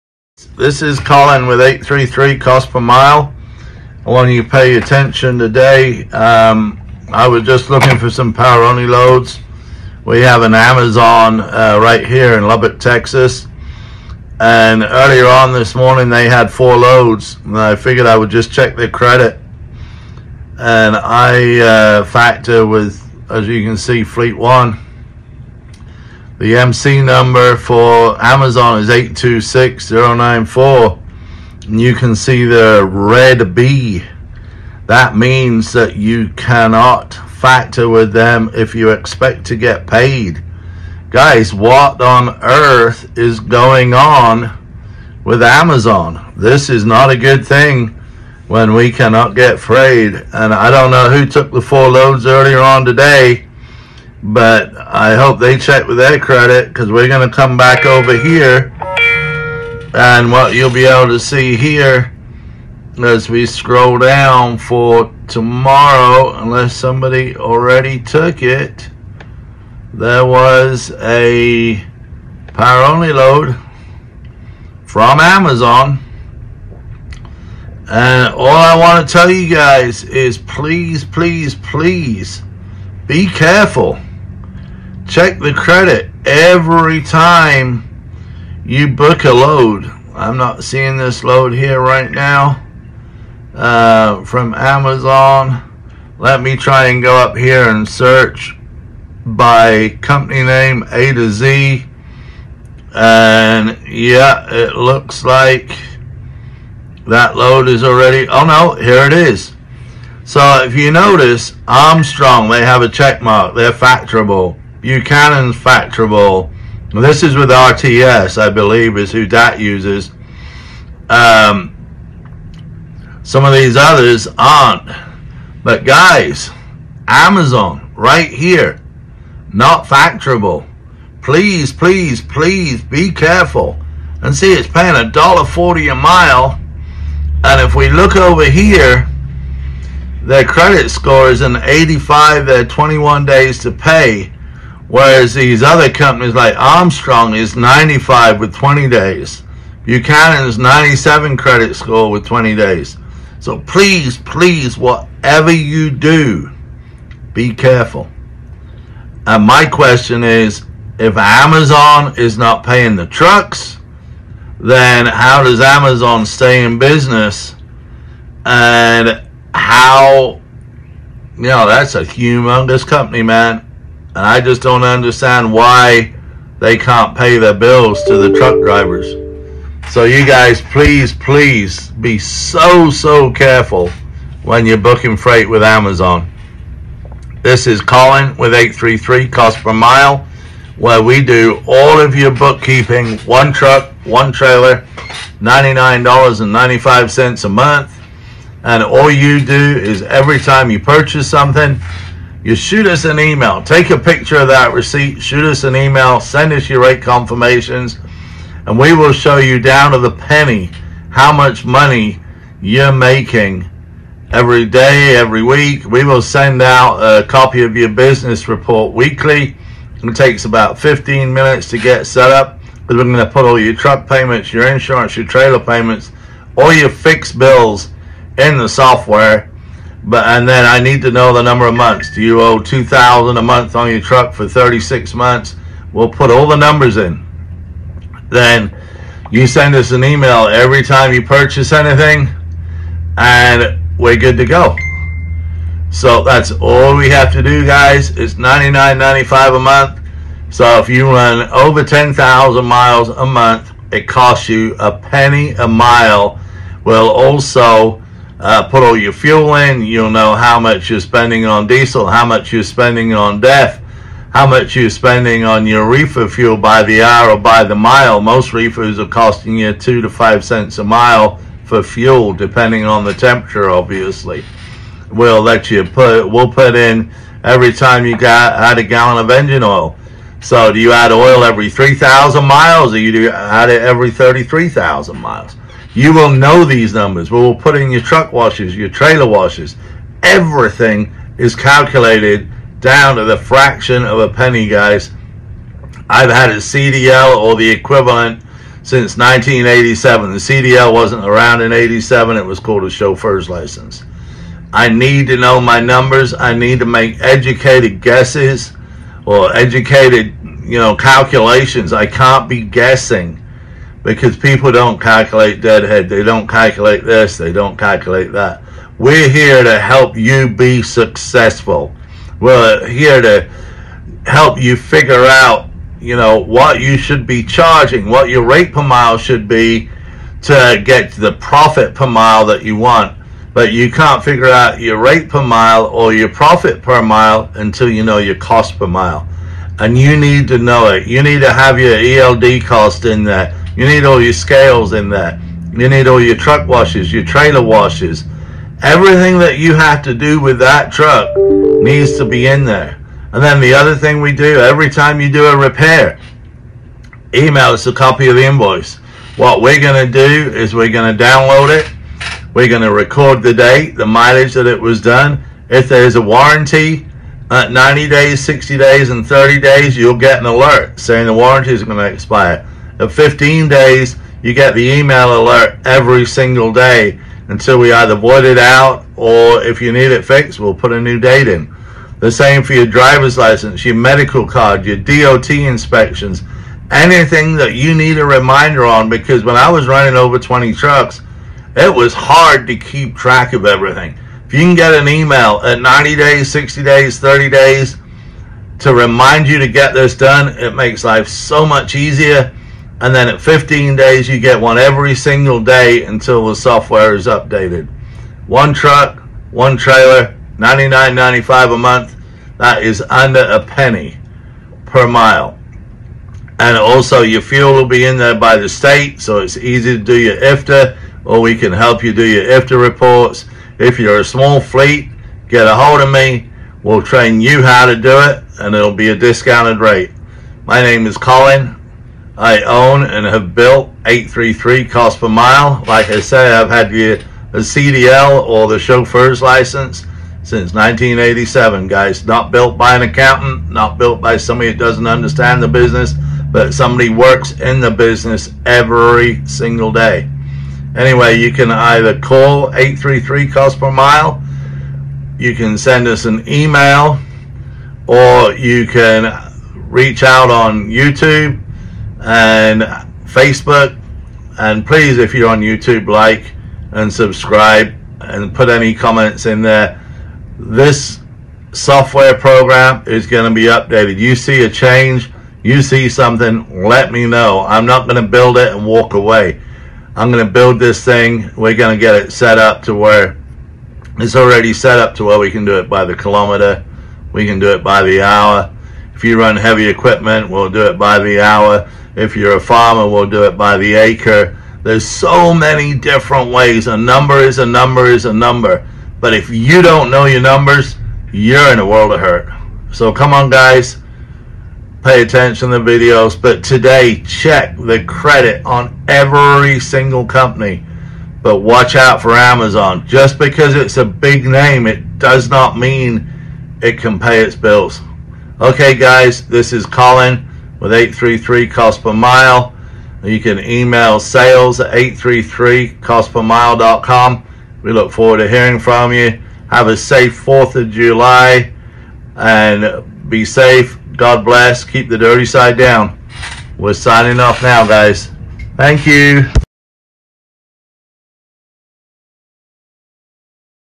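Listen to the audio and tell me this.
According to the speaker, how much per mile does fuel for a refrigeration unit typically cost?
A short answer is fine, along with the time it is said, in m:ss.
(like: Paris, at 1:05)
2 to 5 cents, at 4:29.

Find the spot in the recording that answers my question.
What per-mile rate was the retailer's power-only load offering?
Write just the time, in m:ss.
2:14.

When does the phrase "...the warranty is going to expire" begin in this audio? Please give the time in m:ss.
6:11.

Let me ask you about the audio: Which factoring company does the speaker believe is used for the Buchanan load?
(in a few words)
RTS.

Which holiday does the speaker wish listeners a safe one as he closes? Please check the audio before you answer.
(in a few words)
4th of July.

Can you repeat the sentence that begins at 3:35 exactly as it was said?
We will send out a copy of your business report weekly.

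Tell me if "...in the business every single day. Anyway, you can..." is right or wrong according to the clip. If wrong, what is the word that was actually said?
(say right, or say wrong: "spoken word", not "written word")
right.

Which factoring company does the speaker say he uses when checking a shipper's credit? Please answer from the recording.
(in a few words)
Fleet One.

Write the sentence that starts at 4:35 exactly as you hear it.
We'll let you put, we'll put in every time you got, add a gallon of engine oil.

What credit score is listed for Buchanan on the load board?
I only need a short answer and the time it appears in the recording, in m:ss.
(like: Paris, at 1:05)
97, at 2:30.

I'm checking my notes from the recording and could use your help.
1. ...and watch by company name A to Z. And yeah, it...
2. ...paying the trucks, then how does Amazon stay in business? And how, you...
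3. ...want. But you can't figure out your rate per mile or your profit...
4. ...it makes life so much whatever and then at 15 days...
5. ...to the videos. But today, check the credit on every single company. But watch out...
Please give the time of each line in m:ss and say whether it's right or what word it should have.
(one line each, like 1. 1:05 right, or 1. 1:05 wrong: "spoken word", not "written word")
1. 1:37 wrong: "search", not "watch"
2. 2:42 right
3. 5:32 right
4. 6:40 wrong: "easier", not "whatever"
5. 8:25 right.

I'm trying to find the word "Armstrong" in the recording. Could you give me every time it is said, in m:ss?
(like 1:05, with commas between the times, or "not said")
1:51, 2:26.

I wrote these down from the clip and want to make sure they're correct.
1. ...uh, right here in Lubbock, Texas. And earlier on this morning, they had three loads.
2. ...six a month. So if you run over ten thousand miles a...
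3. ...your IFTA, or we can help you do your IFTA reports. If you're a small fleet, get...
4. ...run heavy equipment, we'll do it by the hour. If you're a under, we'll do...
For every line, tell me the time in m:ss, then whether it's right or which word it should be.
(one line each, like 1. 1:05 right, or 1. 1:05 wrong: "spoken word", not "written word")
1. 0:11 wrong: "four", not "three"
2. 4:09 wrong: "five", not "six"
3. 7:00 right
4. 8:09 wrong: "farmer", not "under".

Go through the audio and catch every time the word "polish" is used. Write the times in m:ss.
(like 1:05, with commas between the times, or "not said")
not said.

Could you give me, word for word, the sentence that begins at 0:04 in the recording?
I want you to pay attention today.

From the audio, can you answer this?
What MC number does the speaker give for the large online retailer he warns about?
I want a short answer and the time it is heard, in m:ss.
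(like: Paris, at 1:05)
826094, at 0:28.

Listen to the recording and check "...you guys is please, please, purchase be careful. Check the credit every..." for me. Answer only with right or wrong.
wrong.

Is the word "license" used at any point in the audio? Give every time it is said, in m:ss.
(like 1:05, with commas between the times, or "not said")
5:03, 6:23, 7:19.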